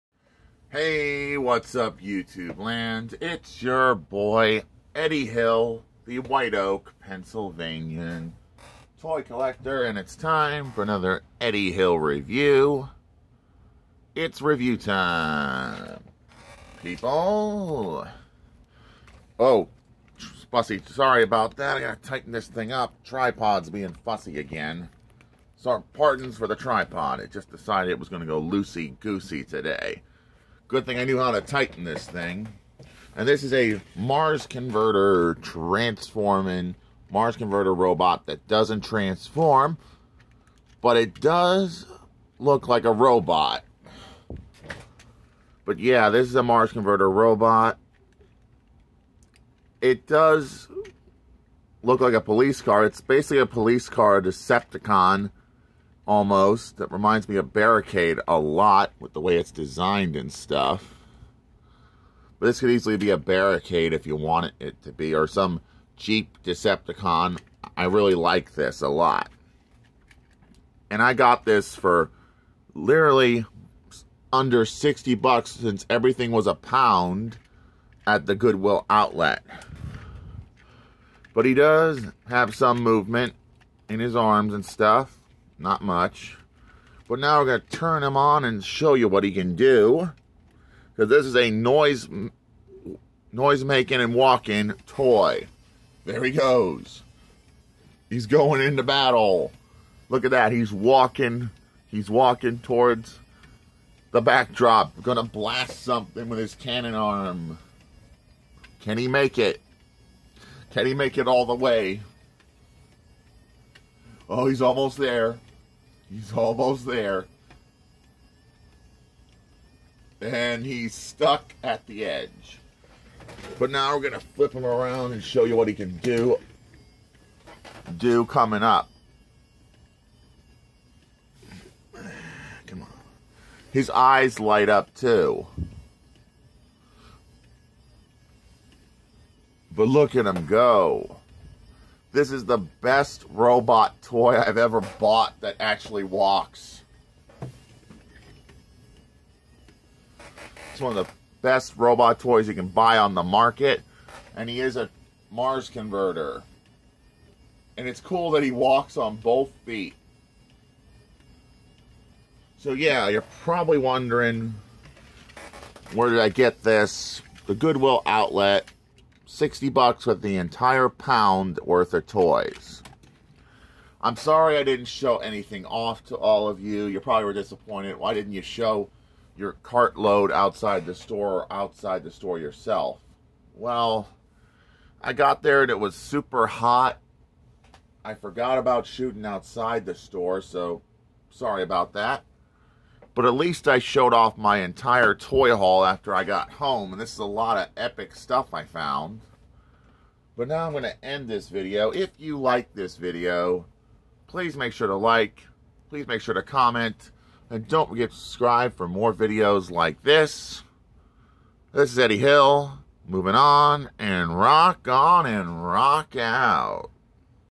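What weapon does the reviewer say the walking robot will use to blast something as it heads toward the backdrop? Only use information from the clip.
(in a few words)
cannon arm.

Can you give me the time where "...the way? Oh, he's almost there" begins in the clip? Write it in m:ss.
1:51.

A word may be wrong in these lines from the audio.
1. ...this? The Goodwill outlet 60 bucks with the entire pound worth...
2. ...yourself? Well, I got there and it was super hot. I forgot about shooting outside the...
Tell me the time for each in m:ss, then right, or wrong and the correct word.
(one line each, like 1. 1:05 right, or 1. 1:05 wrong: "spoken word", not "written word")
1. 2:46 right
2. 3:02 right.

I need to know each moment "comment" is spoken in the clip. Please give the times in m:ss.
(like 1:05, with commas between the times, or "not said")
3:26.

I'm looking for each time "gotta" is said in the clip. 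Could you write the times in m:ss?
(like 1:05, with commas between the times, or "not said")
0:21.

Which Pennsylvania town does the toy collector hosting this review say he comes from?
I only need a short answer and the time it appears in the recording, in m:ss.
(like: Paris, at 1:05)
White Oak, at 0:06.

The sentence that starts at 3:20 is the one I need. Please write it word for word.
But now I'm going to end this video.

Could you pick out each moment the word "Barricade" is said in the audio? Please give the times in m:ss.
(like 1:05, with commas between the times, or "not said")
0:57, 1:03.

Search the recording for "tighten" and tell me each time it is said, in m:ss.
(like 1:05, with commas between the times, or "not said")
0:21, 0:31.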